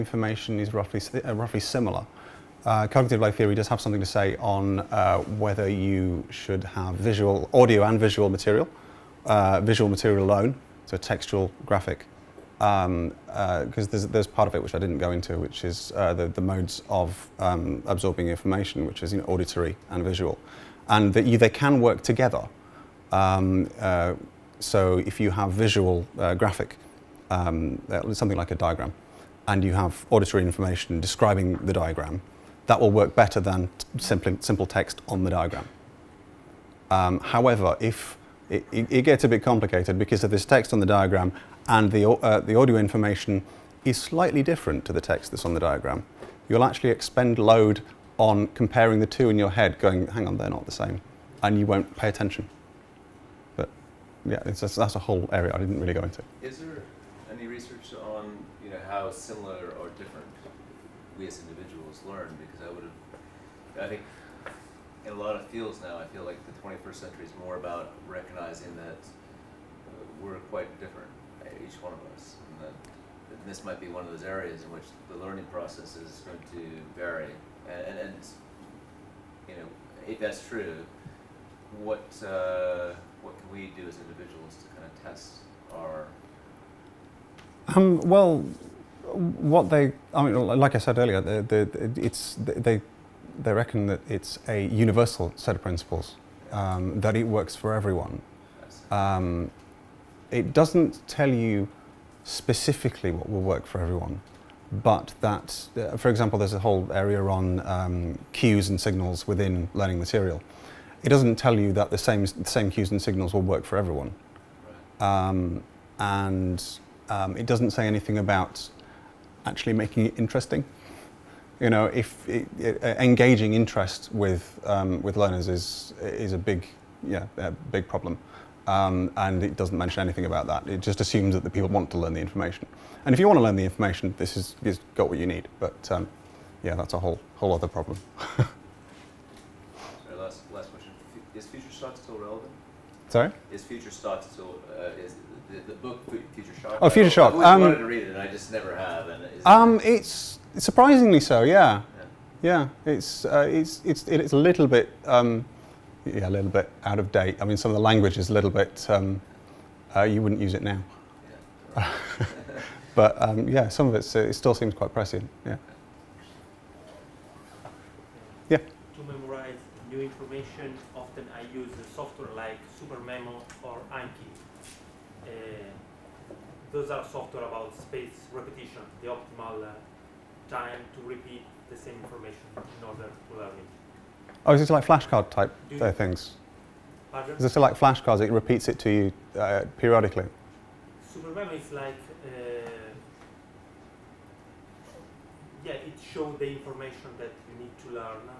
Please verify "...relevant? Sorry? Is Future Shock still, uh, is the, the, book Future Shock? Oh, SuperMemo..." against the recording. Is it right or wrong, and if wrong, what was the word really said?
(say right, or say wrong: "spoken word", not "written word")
wrong: "Future", not "SuperMemo".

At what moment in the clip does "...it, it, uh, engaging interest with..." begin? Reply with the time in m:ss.
2:02.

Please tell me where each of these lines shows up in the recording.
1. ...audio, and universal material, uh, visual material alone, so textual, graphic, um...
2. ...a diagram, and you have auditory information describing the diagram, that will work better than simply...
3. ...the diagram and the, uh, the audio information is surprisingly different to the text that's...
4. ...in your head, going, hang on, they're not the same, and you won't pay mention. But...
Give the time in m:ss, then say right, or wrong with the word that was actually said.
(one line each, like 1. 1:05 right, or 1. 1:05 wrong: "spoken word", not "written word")
1. 0:07 wrong: "visual", not "universal"
2. 0:28 right
3. 0:40 wrong: "slightly", not "surprisingly"
4. 0:49 wrong: "attention", not "mention".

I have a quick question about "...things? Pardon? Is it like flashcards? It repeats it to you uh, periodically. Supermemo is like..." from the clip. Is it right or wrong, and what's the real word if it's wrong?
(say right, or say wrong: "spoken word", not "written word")
right.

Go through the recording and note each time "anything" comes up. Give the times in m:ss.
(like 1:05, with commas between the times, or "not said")
1:57, 2:10.